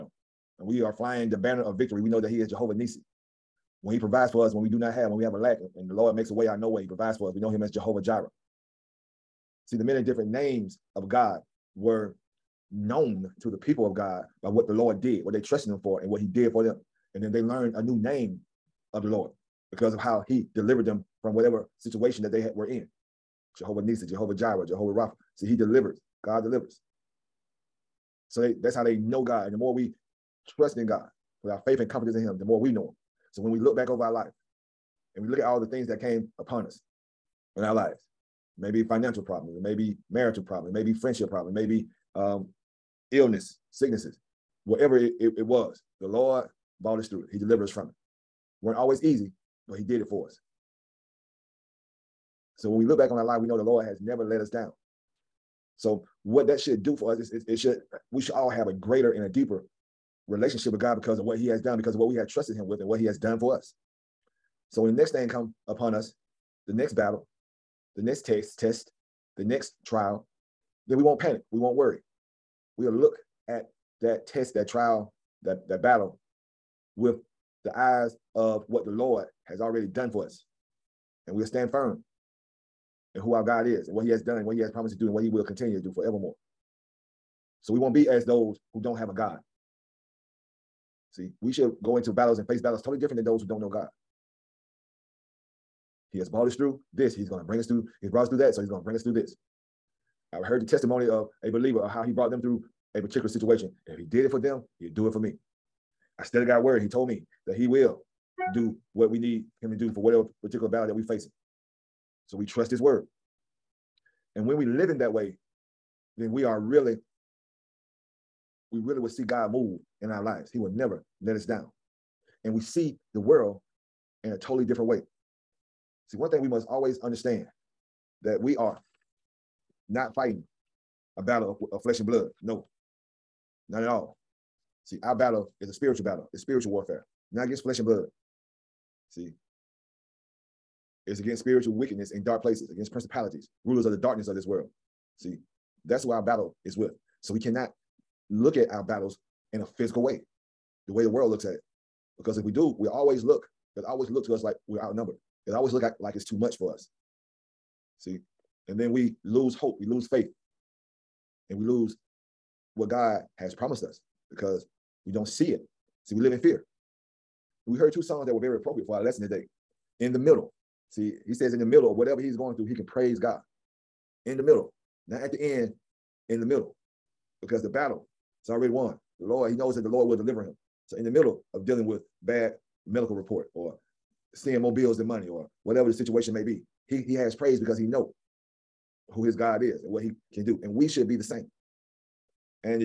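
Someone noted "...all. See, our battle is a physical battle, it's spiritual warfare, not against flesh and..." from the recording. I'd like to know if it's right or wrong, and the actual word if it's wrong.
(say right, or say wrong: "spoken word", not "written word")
wrong: "spiritual", not "physical".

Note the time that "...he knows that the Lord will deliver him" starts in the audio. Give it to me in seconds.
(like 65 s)
179 s.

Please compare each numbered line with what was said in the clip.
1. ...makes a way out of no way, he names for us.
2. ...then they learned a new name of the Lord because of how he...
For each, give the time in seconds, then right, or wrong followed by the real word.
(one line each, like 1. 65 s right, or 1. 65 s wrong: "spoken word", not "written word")
1. 6 s wrong: "provides", not "names"
2. 17 s right.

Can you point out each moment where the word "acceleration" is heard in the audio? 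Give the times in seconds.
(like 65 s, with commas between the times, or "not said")
not said.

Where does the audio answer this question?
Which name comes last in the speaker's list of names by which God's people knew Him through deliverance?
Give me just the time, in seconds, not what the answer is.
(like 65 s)
24 s.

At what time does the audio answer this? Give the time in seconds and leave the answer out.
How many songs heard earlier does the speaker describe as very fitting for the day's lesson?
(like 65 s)
167 s.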